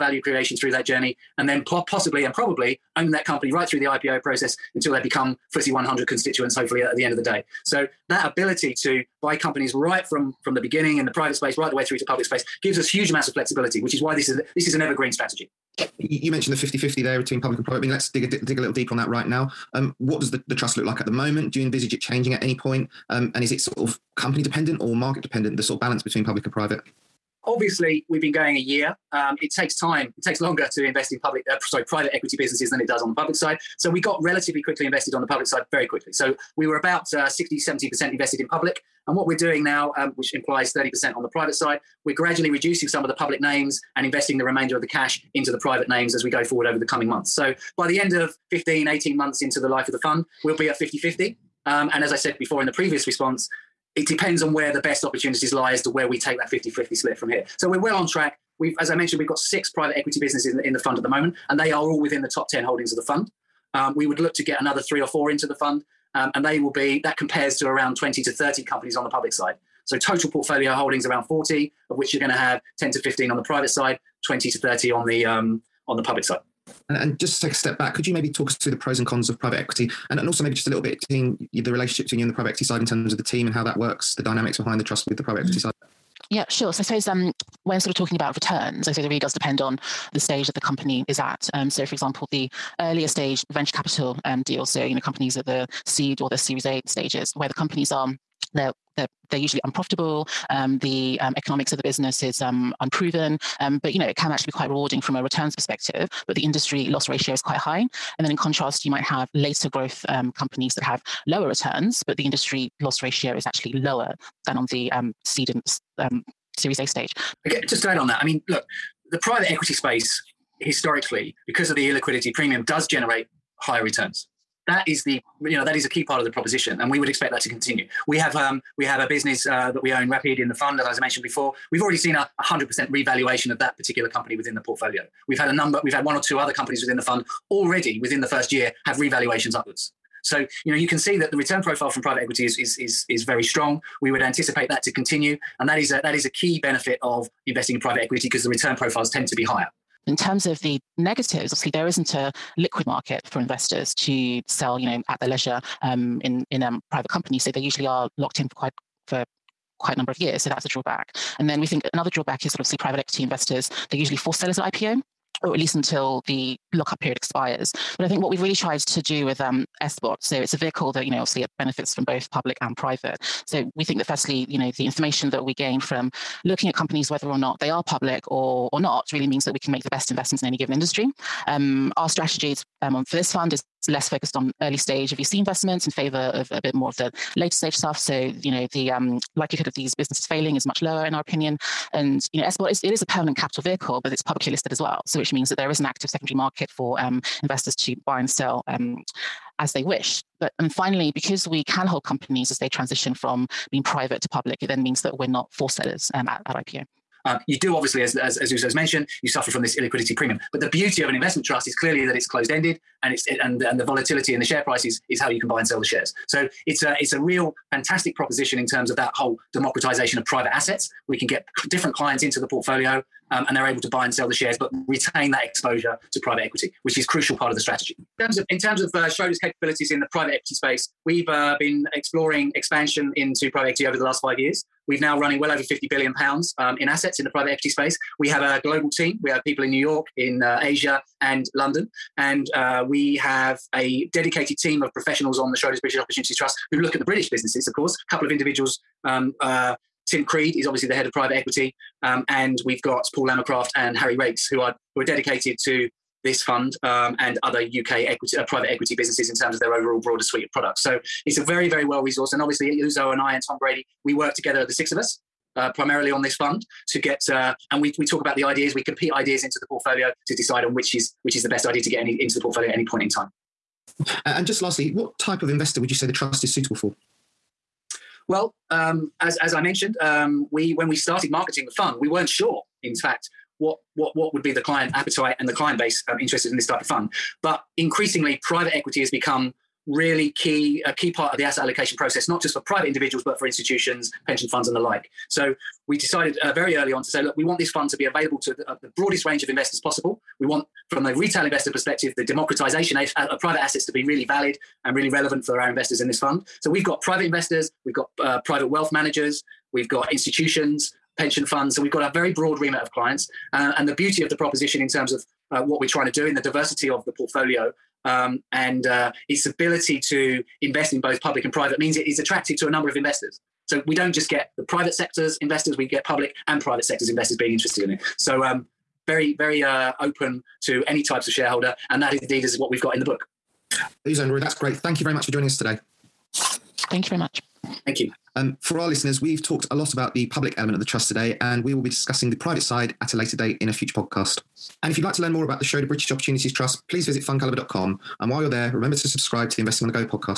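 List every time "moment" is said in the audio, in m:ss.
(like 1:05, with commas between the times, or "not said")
0:21, 1:01.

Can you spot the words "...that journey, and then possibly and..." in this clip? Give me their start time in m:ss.
0:00.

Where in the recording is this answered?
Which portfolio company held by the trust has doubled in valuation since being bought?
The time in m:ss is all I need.
2:10.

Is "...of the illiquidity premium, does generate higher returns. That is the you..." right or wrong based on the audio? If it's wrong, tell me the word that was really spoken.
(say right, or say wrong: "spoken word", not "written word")
right.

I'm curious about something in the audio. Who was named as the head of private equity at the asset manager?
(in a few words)
Tim Creed.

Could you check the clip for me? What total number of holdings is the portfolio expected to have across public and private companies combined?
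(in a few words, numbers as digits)
40.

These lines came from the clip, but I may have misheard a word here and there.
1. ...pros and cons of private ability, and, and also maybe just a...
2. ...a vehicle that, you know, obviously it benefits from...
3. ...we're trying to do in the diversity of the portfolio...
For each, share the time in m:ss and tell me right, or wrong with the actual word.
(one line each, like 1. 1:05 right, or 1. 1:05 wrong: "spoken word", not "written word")
1. 1:18 wrong: "equity", not "ability"
2. 2:50 right
3. 5:15 right.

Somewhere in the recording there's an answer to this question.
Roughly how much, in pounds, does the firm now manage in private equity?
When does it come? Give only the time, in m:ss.
3:55.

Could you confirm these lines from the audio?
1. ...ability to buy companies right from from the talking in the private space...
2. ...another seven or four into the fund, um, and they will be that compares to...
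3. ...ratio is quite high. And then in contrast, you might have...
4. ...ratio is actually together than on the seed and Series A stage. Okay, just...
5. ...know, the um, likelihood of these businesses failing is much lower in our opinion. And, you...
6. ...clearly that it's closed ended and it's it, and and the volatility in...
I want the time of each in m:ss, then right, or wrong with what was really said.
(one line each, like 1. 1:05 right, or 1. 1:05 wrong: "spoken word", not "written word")
1. 0:08 wrong: "beginning", not "talking"
2. 1:04 wrong: "three", not "seven"
3. 1:47 right
4. 1:53 wrong: "lower", not "together"
5. 3:08 right
6. 3:31 right.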